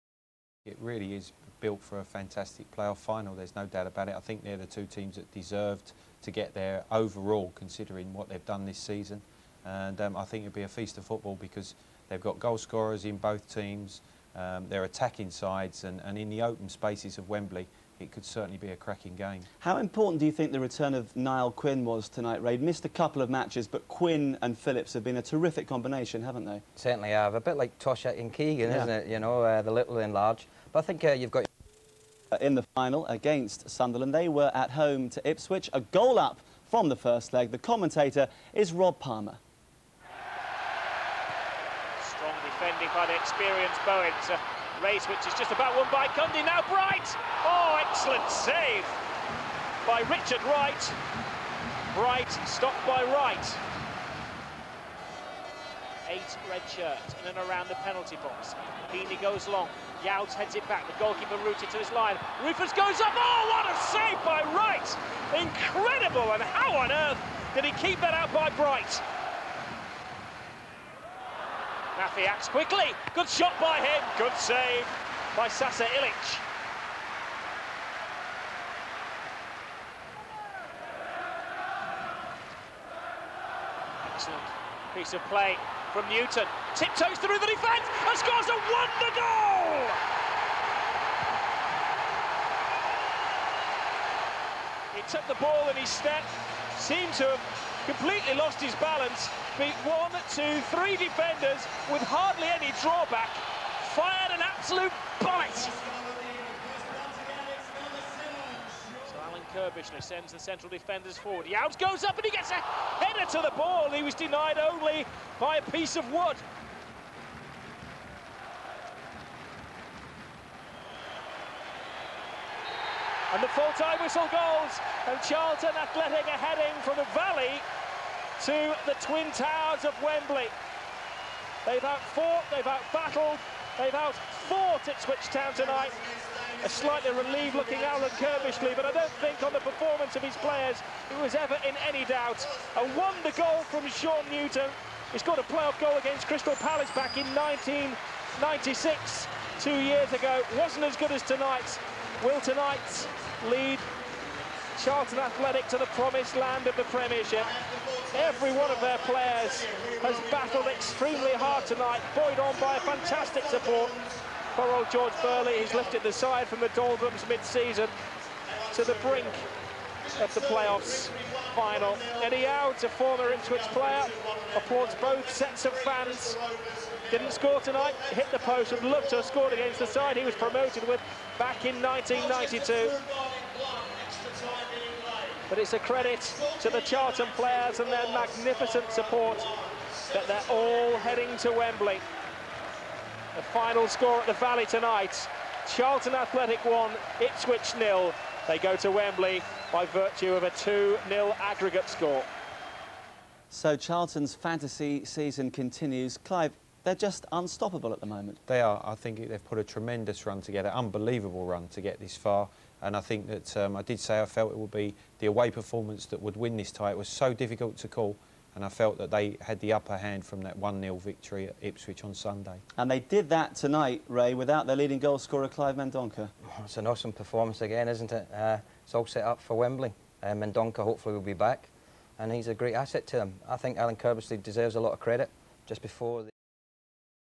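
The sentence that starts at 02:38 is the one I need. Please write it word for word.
Every one of their players has battled extremely hard tonight, buoyed on by a fantastic support.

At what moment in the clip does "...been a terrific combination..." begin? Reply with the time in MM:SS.
00:25.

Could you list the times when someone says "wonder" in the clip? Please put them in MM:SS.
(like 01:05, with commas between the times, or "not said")
01:28, 02:22.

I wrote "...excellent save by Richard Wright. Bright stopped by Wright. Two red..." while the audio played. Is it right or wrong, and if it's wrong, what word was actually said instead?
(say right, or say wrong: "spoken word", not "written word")
wrong: "Eight", not "Two".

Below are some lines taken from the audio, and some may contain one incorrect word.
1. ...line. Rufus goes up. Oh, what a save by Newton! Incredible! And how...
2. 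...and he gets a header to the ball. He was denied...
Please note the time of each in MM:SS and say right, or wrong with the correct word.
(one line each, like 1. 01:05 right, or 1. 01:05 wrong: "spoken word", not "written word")
1. 01:01 wrong: "Wright", not "Newton"
2. 01:52 right.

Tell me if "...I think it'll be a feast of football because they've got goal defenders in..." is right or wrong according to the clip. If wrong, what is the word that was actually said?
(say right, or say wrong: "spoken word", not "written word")
wrong: "scorers", not "defenders".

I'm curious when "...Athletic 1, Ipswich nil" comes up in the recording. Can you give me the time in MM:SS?
03:16.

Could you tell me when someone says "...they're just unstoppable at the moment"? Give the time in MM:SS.
03:26.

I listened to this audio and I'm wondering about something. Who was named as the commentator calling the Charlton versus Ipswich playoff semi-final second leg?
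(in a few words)
Rob Palmer.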